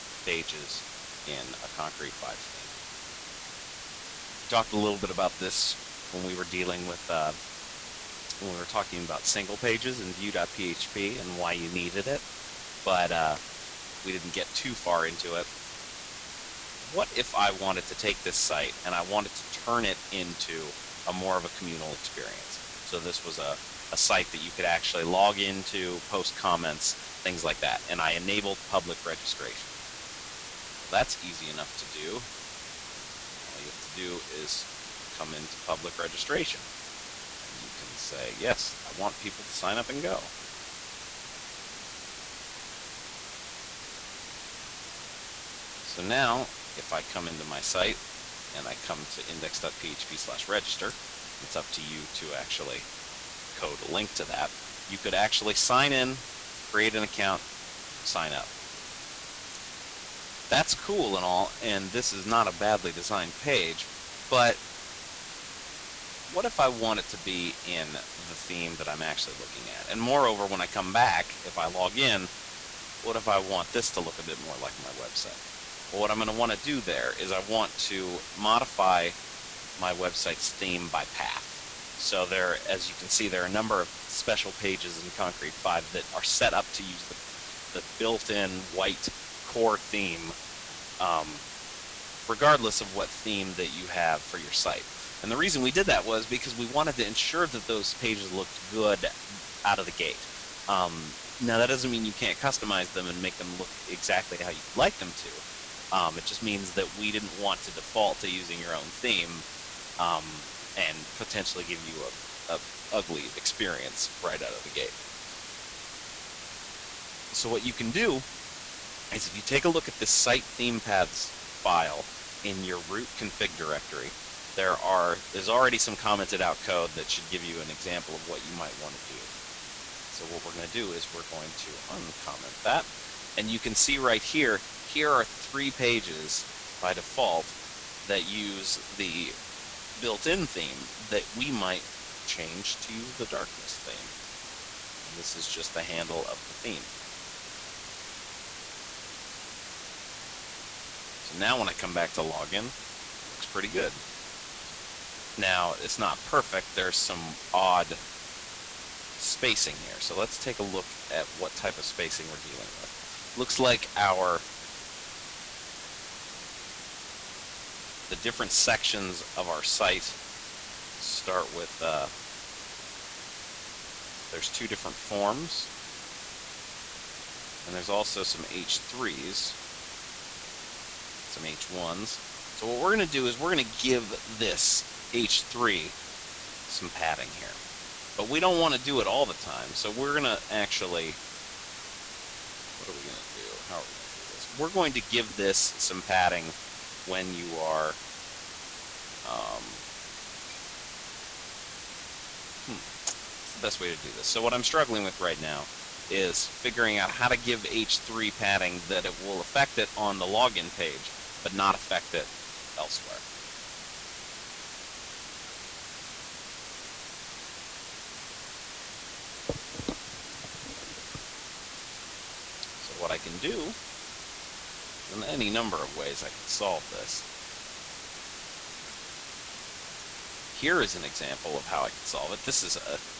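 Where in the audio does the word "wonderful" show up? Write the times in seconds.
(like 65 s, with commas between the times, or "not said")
not said.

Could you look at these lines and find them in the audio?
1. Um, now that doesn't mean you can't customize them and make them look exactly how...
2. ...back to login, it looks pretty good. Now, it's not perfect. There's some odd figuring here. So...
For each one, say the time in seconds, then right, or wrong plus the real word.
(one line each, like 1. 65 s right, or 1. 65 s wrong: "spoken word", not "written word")
1. 100 s right
2. 151 s wrong: "spacing", not "figuring".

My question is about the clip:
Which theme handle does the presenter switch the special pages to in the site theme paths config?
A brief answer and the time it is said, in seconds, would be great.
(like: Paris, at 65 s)
darkness, at 143 s.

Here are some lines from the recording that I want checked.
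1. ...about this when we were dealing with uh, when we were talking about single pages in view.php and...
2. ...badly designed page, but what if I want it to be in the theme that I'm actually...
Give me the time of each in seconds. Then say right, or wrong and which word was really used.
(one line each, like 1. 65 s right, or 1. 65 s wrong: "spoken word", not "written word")
1. 5 s right
2. 62 s right.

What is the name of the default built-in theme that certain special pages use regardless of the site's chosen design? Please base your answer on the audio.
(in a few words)
core.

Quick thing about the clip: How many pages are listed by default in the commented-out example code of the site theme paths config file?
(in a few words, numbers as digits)
3.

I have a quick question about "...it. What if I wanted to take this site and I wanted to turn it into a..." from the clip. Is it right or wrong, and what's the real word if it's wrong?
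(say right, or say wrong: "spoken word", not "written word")
right.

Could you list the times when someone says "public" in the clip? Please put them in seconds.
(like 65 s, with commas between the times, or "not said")
28 s, 35 s.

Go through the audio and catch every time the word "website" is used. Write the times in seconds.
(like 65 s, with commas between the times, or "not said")
74 s, 79 s.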